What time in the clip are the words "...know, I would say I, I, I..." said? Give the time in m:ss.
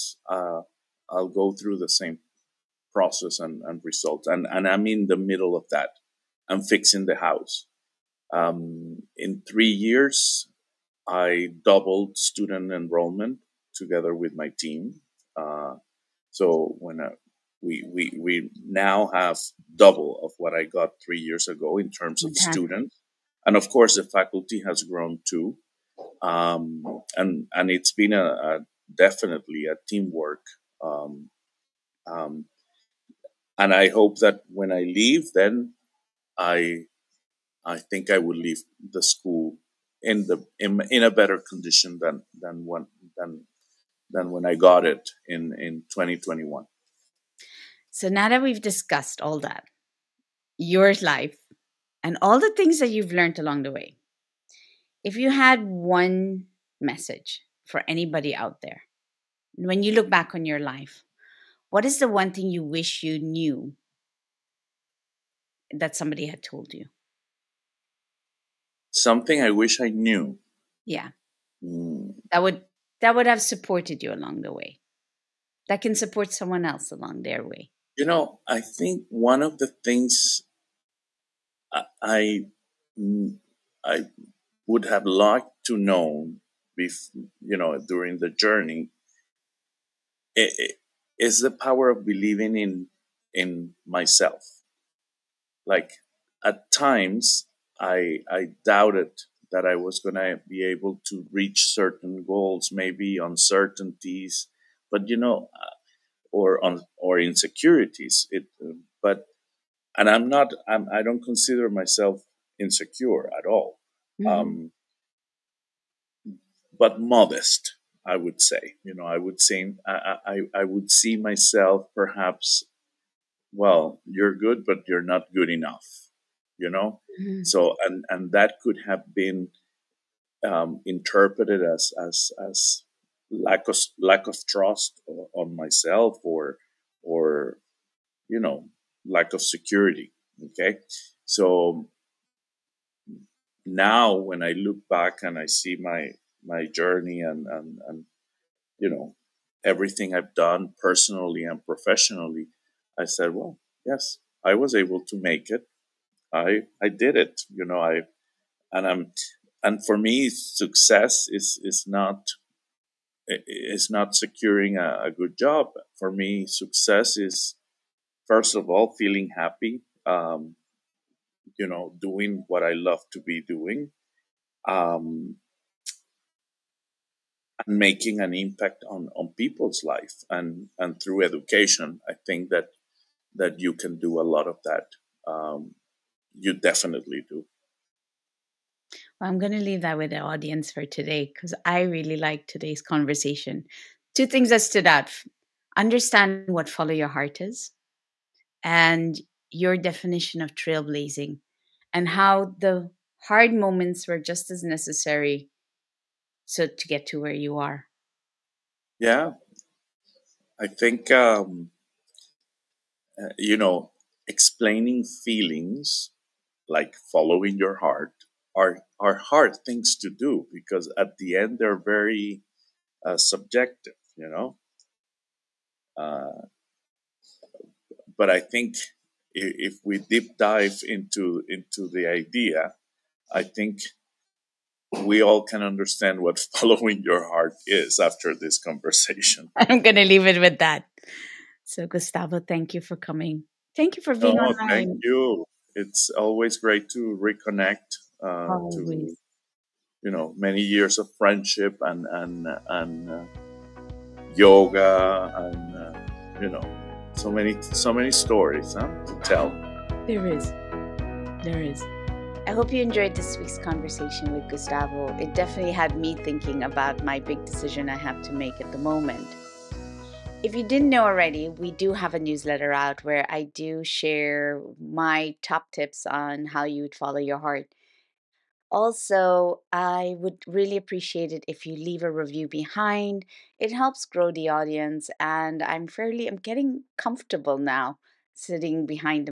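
1:58.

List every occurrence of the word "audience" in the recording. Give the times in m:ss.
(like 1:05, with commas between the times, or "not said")
3:10, 4:44.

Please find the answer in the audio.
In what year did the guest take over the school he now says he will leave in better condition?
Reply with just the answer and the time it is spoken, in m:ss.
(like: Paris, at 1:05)
2021, at 0:45.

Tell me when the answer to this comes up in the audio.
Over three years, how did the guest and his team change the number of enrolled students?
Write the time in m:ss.
0:11.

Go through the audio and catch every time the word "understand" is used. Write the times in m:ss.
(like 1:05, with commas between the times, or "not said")
3:15, 3:55.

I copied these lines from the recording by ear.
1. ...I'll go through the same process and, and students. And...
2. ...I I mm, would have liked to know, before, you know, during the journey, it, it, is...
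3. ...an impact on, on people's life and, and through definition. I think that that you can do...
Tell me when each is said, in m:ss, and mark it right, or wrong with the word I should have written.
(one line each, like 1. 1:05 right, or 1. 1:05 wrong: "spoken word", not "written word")
1. 0:01 wrong: "results", not "students"
2. 1:21 right
3. 2:58 wrong: "education", not "definition".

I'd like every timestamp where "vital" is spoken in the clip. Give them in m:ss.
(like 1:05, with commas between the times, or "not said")
not said.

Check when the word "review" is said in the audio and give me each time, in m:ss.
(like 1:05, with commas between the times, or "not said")
4:42.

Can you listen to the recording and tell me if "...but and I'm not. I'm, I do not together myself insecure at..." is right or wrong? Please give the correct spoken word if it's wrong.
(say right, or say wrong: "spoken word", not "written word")
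wrong: "consider", not "together".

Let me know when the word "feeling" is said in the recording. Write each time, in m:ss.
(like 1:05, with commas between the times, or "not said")
2:48, 3:35.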